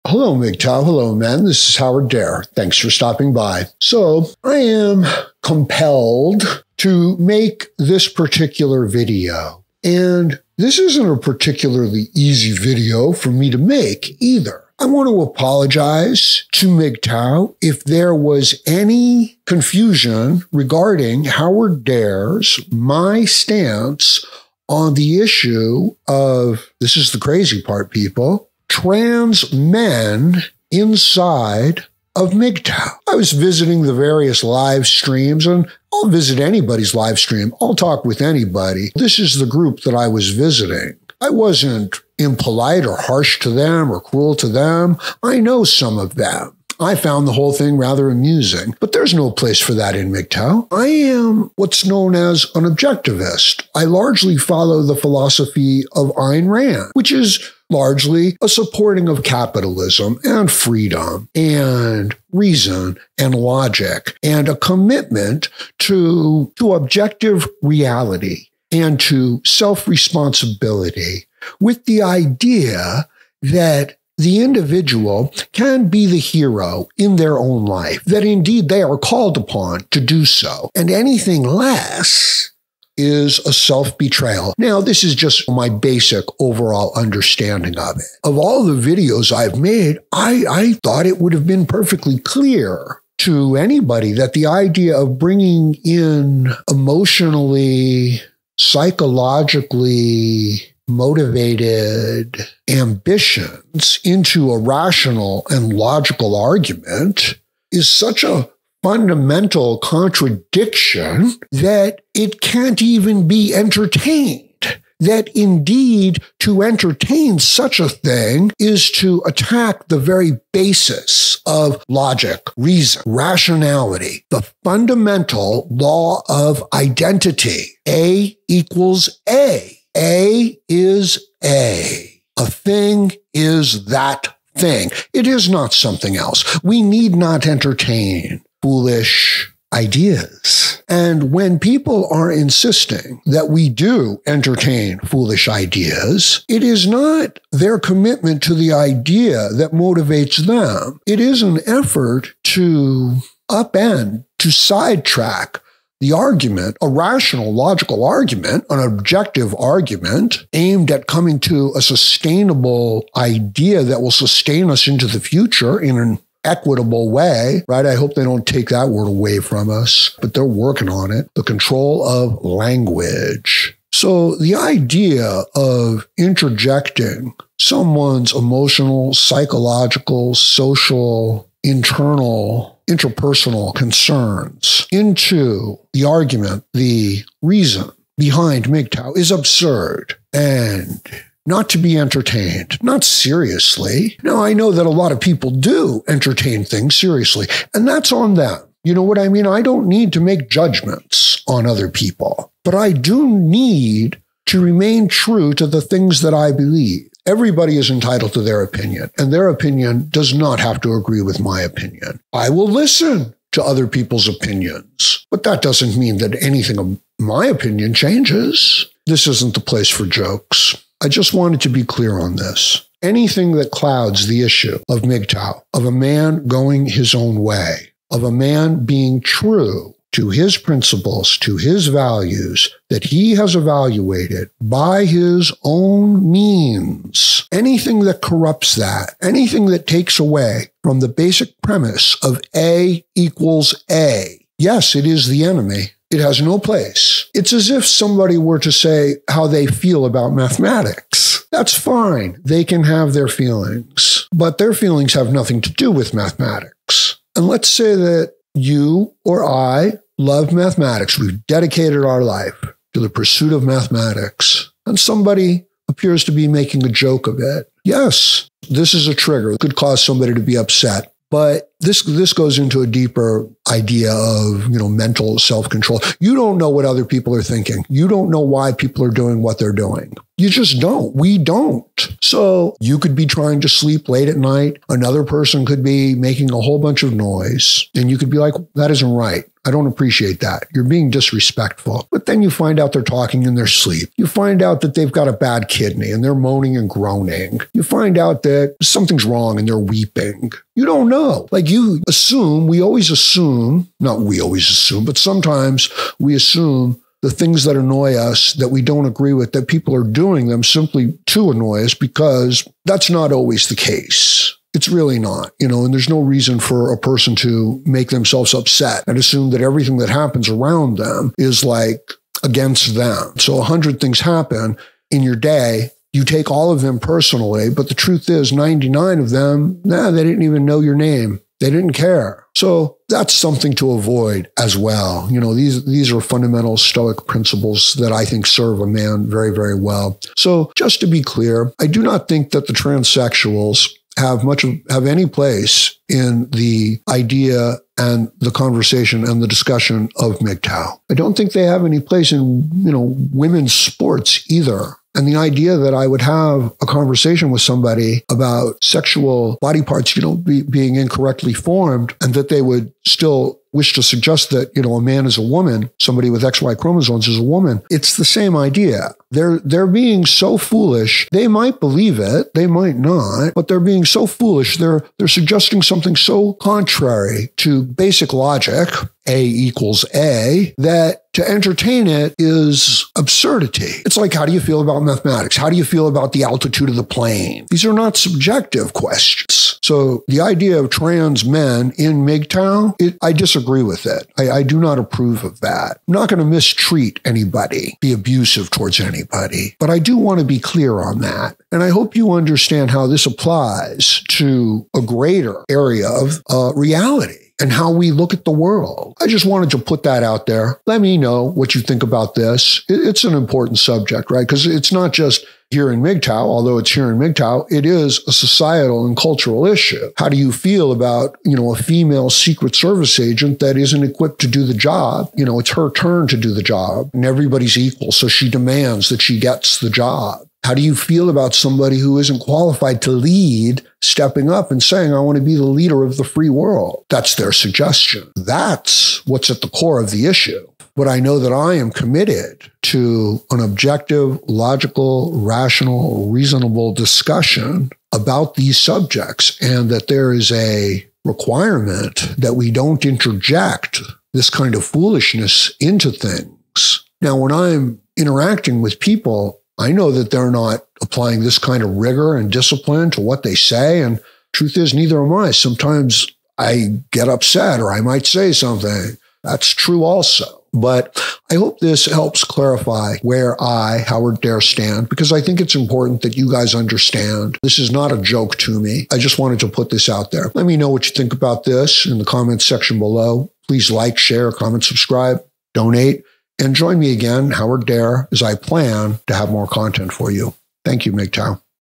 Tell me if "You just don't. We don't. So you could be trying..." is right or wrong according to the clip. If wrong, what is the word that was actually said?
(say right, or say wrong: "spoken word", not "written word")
right.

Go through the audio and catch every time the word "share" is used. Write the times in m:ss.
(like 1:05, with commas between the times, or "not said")
8:04.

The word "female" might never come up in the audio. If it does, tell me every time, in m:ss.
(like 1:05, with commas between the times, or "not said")
7:01.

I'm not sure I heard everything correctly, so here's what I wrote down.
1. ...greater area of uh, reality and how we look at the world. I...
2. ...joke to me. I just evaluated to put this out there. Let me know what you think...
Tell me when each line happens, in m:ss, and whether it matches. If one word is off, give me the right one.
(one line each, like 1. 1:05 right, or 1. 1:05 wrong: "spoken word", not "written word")
1. 6:45 right
2. 7:58 wrong: "wanted", not "evaluated".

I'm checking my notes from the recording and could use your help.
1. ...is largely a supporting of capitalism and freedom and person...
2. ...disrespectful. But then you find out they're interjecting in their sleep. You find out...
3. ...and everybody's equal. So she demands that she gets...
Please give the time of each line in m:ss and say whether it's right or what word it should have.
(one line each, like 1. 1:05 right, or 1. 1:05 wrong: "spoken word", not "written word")
1. 0:57 wrong: "reason", not "person"
2. 4:51 wrong: "talking", not "interjecting"
3. 7:07 right.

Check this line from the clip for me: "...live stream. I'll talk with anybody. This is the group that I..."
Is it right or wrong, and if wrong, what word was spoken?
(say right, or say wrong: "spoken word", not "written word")
right.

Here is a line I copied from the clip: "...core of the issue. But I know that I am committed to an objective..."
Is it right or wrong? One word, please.
right.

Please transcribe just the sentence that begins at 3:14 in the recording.
Now, I know that a lot of people do entertain things seriously, and that's on them.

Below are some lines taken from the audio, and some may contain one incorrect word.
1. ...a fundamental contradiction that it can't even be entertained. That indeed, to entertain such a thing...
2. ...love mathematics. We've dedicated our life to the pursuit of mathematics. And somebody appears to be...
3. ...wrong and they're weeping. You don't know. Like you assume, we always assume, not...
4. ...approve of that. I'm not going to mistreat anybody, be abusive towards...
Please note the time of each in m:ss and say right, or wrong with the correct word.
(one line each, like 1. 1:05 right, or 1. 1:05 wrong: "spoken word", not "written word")
1. 1:48 right
2. 4:20 right
3. 4:59 right
4. 6:34 right.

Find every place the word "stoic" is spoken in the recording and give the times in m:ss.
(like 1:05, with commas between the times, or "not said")
5:36.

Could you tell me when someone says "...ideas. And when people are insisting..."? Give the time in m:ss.
2:19.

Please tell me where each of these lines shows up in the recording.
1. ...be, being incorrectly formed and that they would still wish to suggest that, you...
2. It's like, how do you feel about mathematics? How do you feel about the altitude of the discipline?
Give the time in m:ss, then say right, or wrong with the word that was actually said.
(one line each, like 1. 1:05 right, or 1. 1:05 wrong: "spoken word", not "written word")
1. 6:00 right
2. 6:24 wrong: "plane", not "discipline".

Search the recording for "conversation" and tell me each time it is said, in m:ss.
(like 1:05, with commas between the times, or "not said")
5:48, 5:56.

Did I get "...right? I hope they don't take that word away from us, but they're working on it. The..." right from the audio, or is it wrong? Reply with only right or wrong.
right.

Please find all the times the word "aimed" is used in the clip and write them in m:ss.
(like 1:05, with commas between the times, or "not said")
2:40.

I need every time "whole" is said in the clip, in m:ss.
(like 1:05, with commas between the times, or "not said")
0:47, 4:46.